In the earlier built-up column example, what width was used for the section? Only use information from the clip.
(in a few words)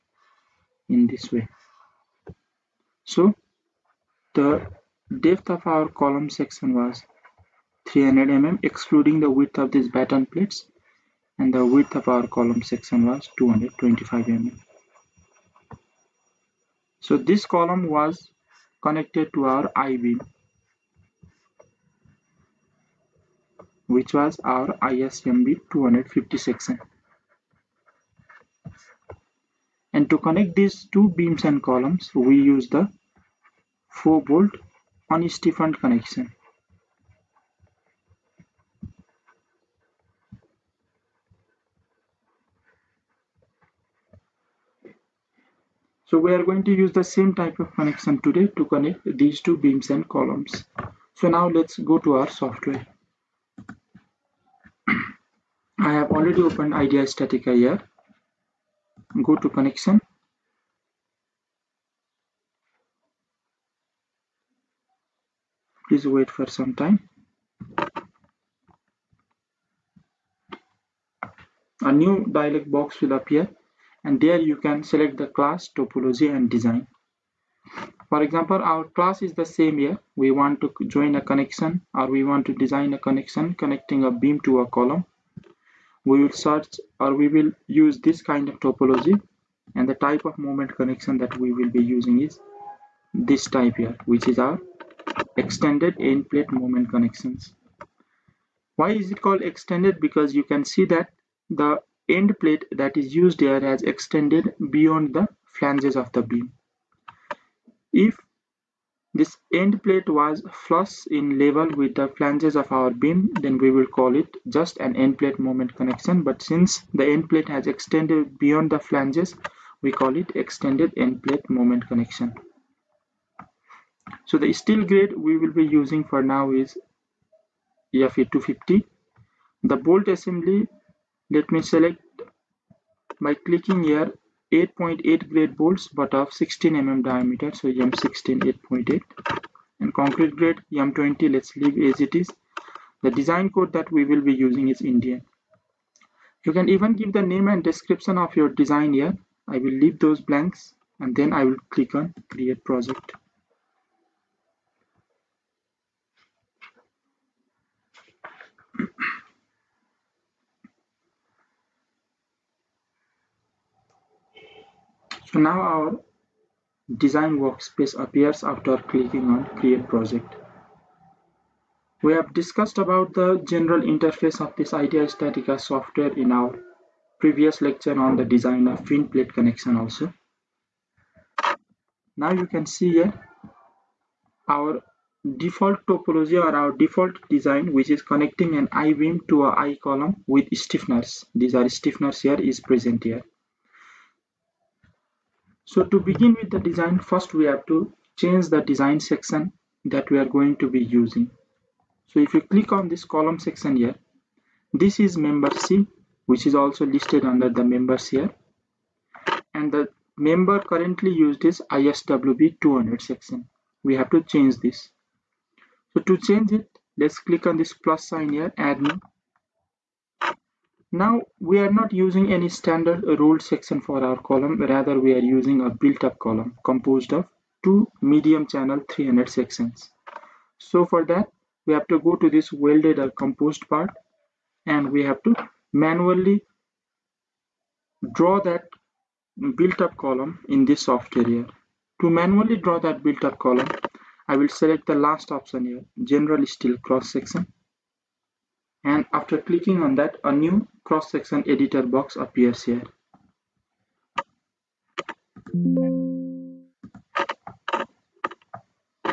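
225 mm.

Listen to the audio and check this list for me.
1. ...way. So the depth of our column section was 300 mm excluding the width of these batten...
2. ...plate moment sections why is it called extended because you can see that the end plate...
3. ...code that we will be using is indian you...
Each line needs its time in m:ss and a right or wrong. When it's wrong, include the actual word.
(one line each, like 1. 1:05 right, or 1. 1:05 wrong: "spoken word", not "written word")
1. 0:01 right
2. 1:36 wrong: "connections", not "sections"
3. 2:23 right.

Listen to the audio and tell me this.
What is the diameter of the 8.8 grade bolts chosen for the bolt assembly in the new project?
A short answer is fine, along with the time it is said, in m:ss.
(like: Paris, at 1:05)
16 mm, at 2:16.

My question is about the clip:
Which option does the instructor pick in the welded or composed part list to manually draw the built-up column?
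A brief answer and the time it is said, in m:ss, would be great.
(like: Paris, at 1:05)
General Steel Cross Section, at 4:06.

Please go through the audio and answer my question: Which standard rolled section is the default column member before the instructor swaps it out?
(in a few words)
ISWB 200.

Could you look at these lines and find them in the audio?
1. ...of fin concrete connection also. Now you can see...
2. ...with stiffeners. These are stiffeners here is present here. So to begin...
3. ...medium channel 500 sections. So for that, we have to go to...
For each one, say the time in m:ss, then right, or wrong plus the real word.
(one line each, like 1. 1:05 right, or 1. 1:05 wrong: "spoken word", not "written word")
1. 2:58 wrong: "plate", not "concrete"
2. 3:10 right
3. 3:48 wrong: "300", not "500".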